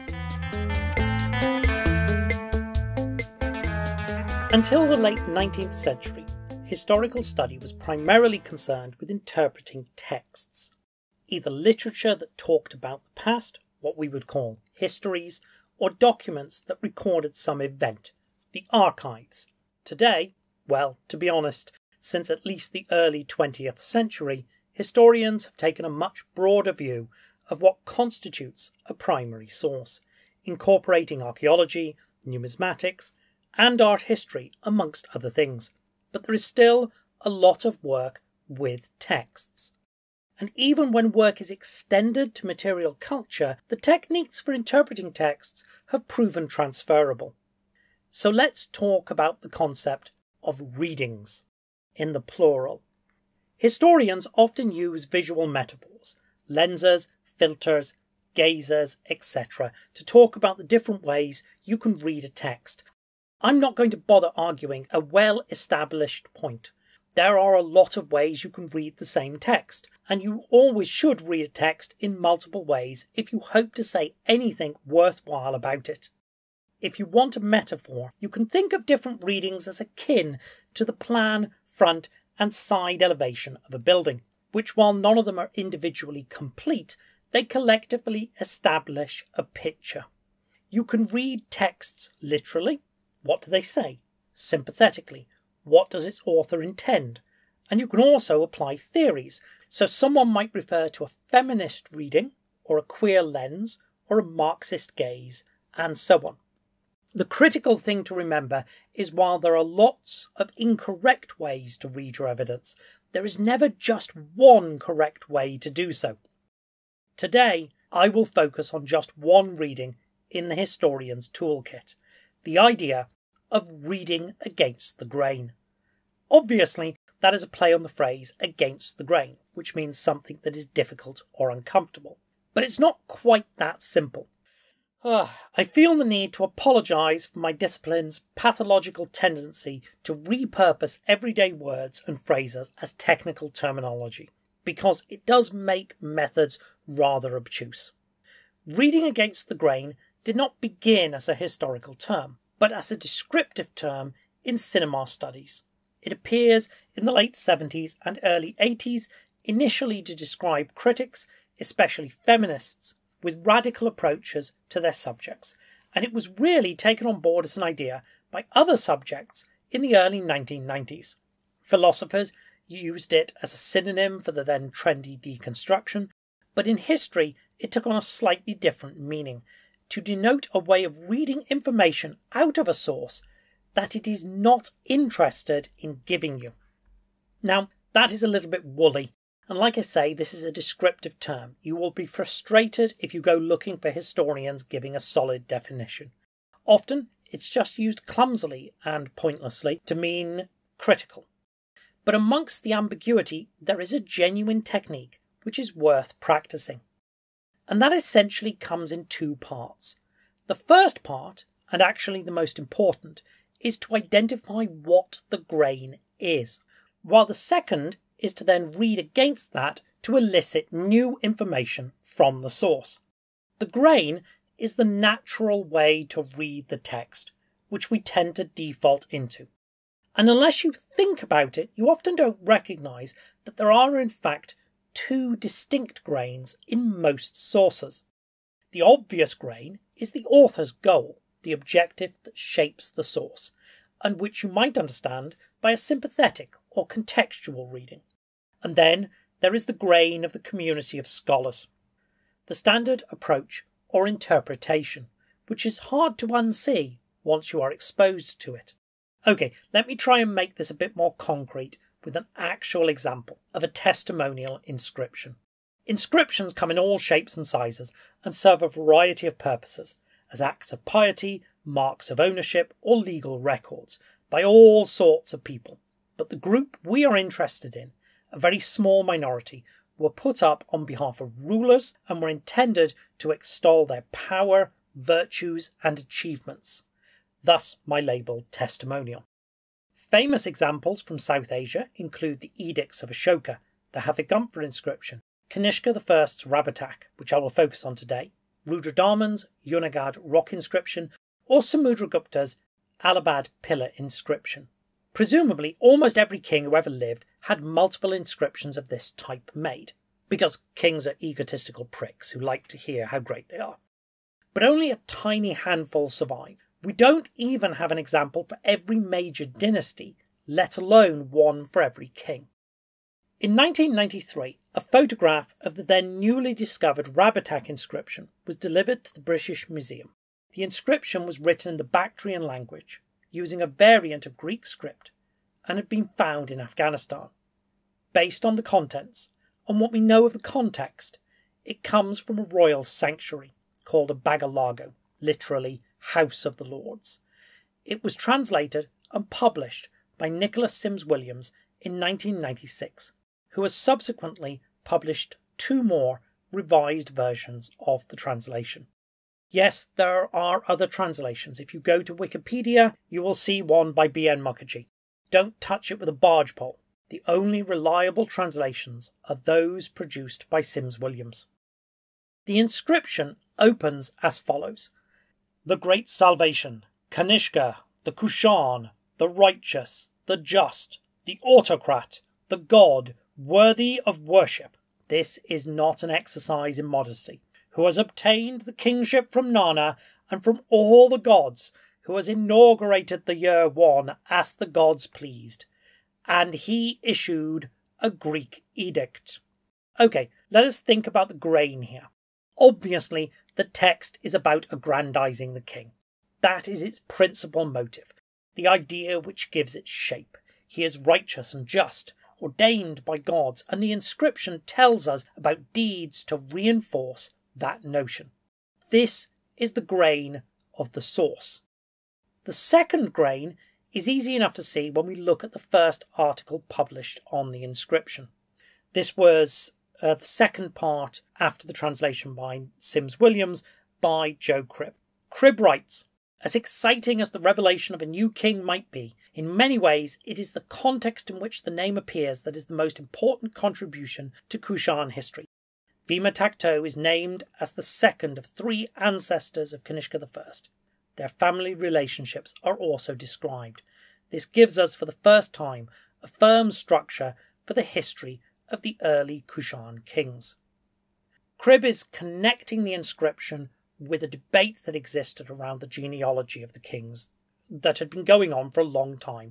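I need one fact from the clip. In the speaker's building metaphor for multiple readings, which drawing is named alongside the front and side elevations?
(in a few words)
The plan.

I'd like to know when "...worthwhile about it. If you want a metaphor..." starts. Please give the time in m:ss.
1:14.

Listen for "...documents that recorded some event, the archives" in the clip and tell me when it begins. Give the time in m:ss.
0:15.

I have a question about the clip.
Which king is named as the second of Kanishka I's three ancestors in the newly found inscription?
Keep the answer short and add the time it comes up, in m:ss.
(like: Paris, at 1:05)
Vima Takto, at 7:26.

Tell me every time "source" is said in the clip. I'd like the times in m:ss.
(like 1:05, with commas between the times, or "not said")
0:29, 3:02, 3:42, 3:57, 4:03, 7:01.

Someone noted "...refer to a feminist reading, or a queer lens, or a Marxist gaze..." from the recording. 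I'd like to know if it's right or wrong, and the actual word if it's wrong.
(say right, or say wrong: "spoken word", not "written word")
right.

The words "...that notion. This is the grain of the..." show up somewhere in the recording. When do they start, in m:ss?
6:57.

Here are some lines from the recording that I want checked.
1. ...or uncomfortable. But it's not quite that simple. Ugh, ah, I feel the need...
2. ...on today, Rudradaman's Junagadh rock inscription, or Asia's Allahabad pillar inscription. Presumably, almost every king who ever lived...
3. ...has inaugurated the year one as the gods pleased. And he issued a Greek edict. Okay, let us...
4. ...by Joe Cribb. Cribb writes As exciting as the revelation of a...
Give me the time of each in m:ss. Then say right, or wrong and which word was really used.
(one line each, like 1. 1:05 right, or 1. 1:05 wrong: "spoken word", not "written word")
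1. 2:11 right
2. 4:57 wrong: "Samudragupta", not "Asia"
3. 6:32 right
4. 7:14 right.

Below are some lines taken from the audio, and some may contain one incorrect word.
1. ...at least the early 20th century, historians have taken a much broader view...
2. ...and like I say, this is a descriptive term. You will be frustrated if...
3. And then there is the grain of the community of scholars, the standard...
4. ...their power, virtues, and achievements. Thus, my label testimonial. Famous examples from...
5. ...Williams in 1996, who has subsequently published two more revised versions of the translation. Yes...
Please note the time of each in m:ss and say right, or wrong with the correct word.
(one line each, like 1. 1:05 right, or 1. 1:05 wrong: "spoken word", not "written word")
1. 0:22 right
2. 3:09 right
3. 4:08 right
4. 4:43 right
5. 5:51 right.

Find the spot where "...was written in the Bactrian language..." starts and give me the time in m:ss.
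5:31.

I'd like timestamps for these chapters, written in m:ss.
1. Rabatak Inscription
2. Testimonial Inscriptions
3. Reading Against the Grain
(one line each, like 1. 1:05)
1. 5:22
2. 4:23
3. 1:59.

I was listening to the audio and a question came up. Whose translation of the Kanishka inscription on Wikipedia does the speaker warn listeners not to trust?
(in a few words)
B.N. Mukherjee.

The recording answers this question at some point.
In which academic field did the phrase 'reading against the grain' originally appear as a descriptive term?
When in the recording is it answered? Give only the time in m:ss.
2:34.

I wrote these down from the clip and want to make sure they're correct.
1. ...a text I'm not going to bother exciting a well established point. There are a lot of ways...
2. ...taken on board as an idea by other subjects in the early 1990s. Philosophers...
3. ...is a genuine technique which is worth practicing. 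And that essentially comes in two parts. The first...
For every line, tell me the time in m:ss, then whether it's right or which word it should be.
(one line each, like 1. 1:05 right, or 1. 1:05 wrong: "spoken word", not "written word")
1. 1:02 wrong: "arguing", not "exciting"
2. 2:46 right
3. 3:23 right.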